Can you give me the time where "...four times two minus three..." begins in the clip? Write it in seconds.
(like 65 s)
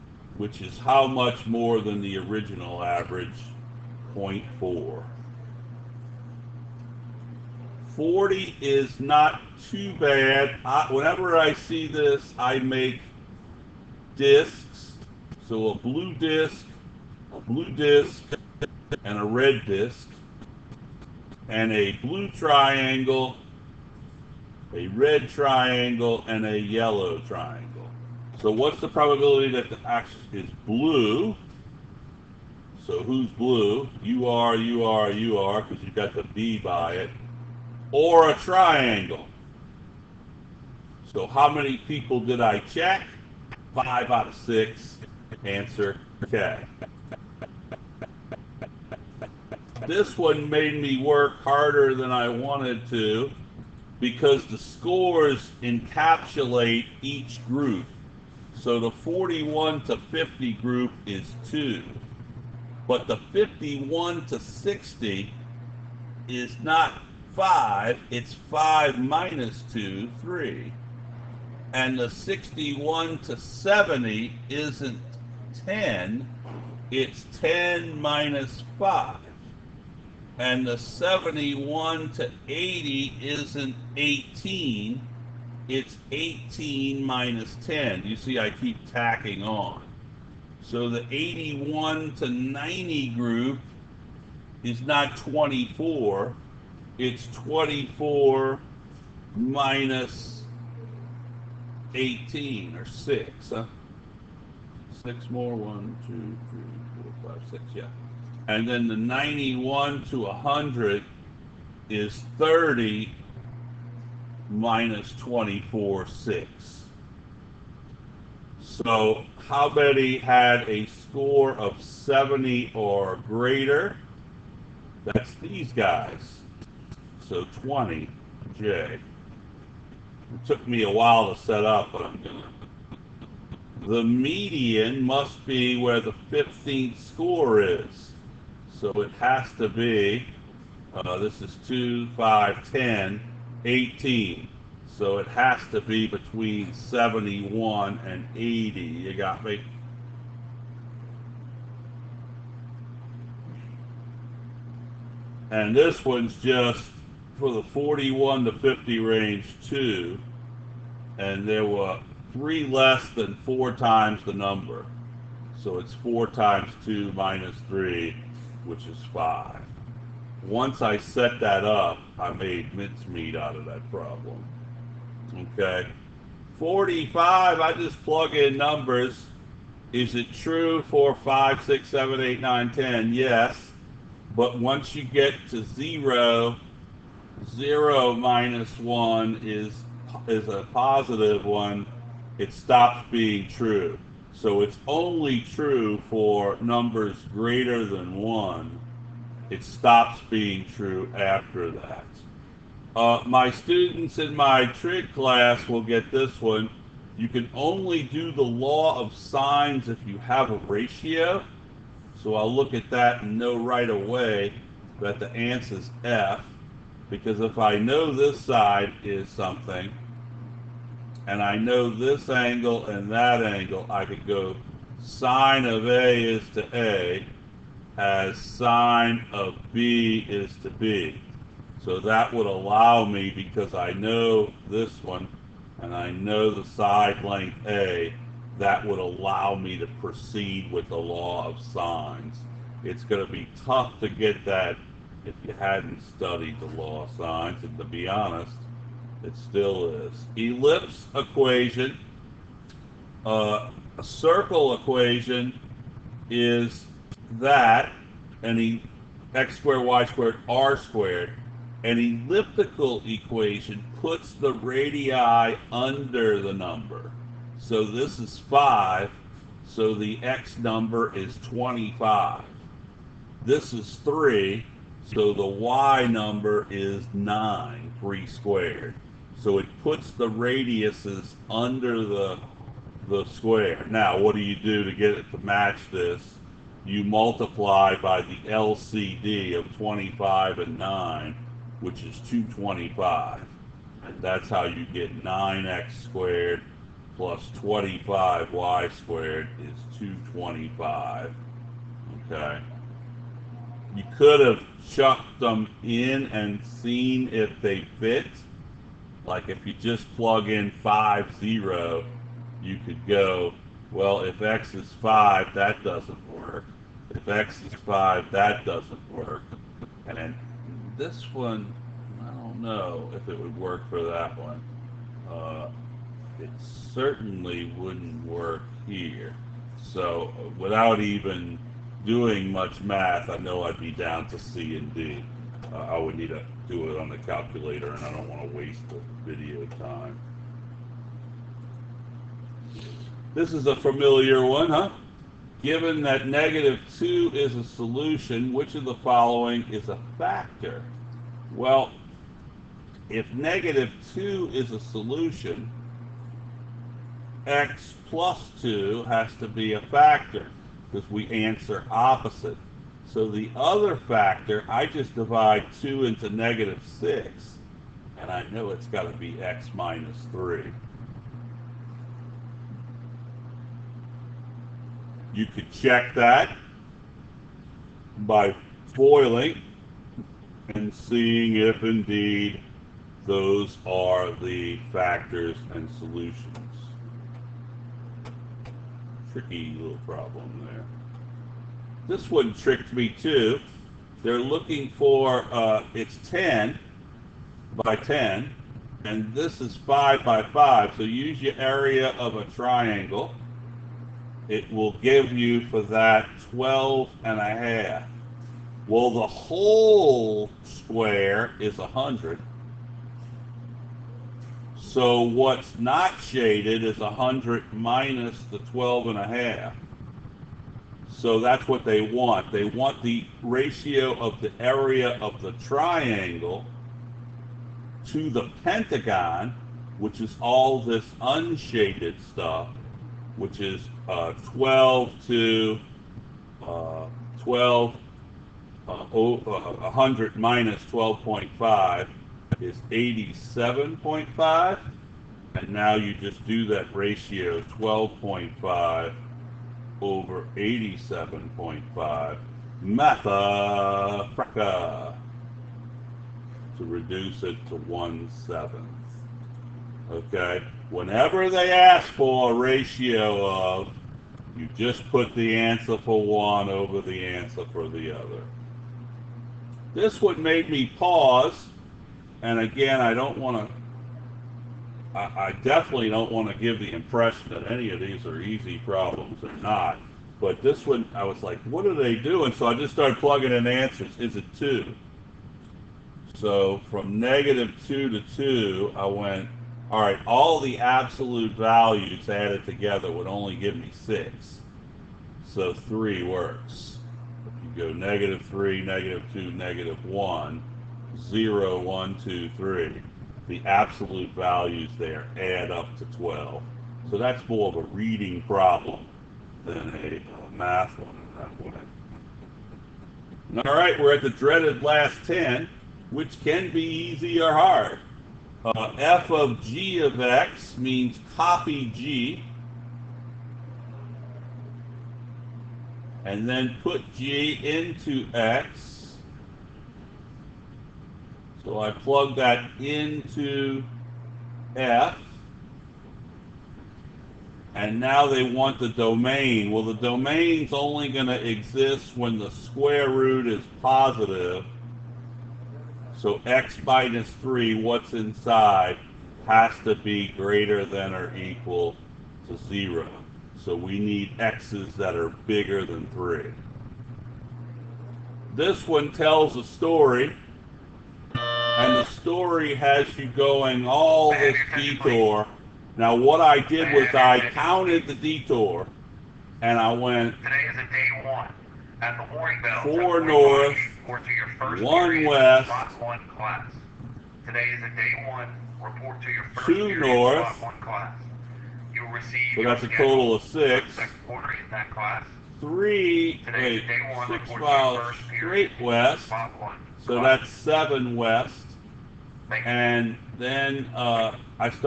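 165 s.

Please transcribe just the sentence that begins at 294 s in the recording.
That's how you get 9x squared plus 25y squared is 225.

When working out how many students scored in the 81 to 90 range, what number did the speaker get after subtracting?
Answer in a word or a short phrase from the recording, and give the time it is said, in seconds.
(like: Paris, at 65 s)
6, at 97 s.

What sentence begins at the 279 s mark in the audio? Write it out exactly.
So it puts the radiuses under the, the square.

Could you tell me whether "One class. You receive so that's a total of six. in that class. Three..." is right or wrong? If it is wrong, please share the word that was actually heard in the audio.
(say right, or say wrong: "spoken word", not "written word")
right.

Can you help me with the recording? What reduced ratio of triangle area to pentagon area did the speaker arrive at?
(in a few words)
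1/7.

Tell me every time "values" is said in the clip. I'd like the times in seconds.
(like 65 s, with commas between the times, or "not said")
491 s, 504 s.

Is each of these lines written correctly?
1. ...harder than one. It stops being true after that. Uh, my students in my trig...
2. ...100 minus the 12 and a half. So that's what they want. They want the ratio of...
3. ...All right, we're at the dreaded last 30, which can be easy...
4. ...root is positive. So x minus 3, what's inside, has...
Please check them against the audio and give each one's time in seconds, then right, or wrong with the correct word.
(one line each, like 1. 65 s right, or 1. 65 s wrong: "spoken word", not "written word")
1. 197 s wrong: "greater", not "harder"
2. 416 s right
3. 513 s wrong: "10", not "30"
4. 543 s right.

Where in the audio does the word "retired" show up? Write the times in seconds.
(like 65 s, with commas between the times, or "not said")
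not said.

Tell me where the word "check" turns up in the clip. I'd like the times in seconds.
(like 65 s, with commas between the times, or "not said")
42 s, 375 s.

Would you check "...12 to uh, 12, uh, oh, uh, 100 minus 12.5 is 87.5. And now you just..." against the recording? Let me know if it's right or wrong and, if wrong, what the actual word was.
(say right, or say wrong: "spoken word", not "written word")
right.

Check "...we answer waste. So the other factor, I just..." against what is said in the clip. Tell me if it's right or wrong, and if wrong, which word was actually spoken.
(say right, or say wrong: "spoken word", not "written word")
wrong: "opposite", not "waste".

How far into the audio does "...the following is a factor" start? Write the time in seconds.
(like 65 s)
348 s.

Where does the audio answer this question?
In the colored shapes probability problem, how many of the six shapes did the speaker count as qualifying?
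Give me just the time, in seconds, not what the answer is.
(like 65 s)
43 s.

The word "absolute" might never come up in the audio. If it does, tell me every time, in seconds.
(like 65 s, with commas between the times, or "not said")
490 s, 503 s.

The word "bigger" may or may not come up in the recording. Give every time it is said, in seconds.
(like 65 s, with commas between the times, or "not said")
555 s.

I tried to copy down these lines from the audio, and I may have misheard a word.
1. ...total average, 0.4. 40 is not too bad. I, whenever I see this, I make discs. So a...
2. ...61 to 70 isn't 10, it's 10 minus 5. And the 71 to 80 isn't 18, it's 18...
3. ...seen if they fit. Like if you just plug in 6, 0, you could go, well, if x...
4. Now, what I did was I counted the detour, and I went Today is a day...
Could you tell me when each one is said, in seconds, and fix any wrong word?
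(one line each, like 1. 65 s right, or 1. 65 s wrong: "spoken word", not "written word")
1. 2 s wrong: "original", not "total"
2. 72 s right
3. 306 s wrong: "5", not "6"
4. 565 s right.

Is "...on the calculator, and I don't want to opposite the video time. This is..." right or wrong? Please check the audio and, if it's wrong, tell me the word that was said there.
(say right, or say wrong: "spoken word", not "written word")
wrong: "waste", not "opposite".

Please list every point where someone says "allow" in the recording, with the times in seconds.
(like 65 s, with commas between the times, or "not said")
232 s, 238 s.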